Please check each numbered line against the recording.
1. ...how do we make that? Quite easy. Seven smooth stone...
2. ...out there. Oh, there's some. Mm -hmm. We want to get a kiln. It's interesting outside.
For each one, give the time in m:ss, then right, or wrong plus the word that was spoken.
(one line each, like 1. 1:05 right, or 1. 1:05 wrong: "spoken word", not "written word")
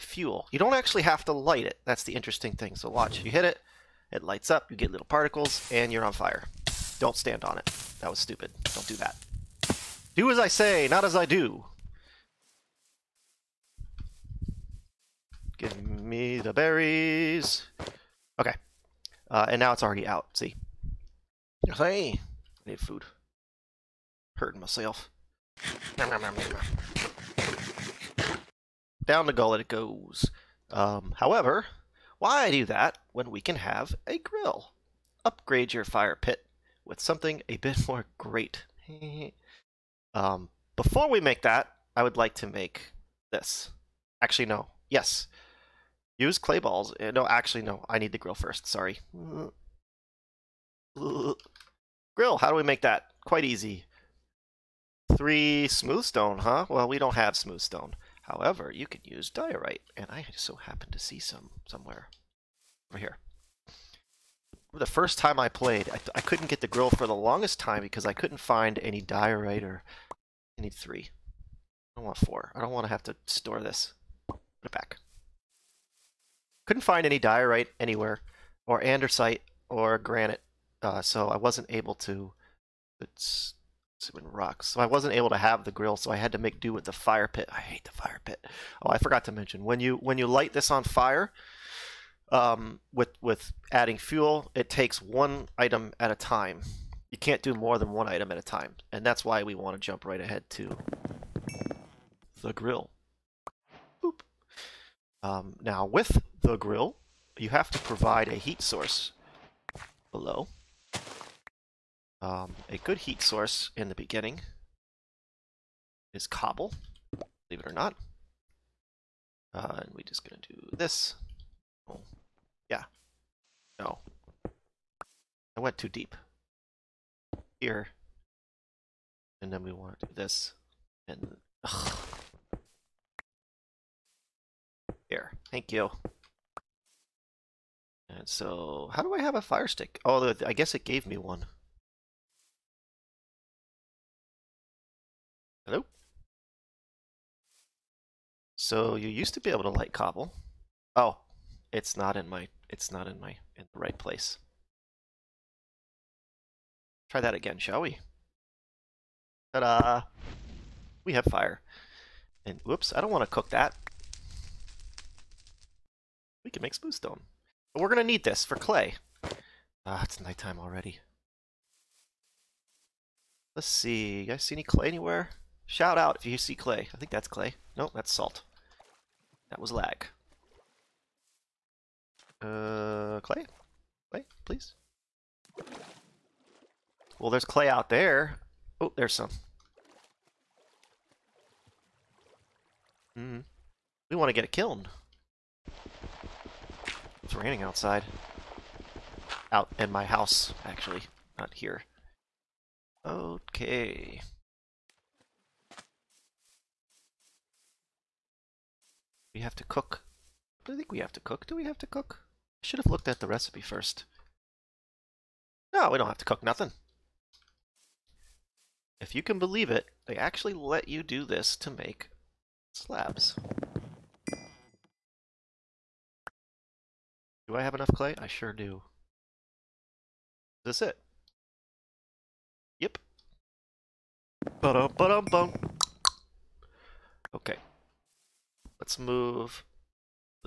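1. 0:52 wrong: "Three", not "Seven"
2. 3:07 wrong: "raining", not "interesting".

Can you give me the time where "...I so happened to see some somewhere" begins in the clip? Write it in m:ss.
1:00.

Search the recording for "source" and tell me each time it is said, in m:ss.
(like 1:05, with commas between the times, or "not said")
1:48, 1:53.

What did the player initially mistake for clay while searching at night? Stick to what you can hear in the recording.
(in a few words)
salt.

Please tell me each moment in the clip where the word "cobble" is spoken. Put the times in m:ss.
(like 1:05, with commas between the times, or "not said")
1:56, 2:29.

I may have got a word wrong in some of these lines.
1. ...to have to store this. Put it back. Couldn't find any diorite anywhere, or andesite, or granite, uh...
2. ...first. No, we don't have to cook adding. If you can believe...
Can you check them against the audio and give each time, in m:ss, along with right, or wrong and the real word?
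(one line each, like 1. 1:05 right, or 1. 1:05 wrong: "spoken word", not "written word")
1. 1:12 right
2. 3:33 wrong: "nothing", not "adding".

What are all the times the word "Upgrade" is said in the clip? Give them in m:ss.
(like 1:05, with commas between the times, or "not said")
0:35.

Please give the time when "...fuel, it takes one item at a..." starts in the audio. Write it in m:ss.
1:33.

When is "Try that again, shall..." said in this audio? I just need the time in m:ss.
2:37.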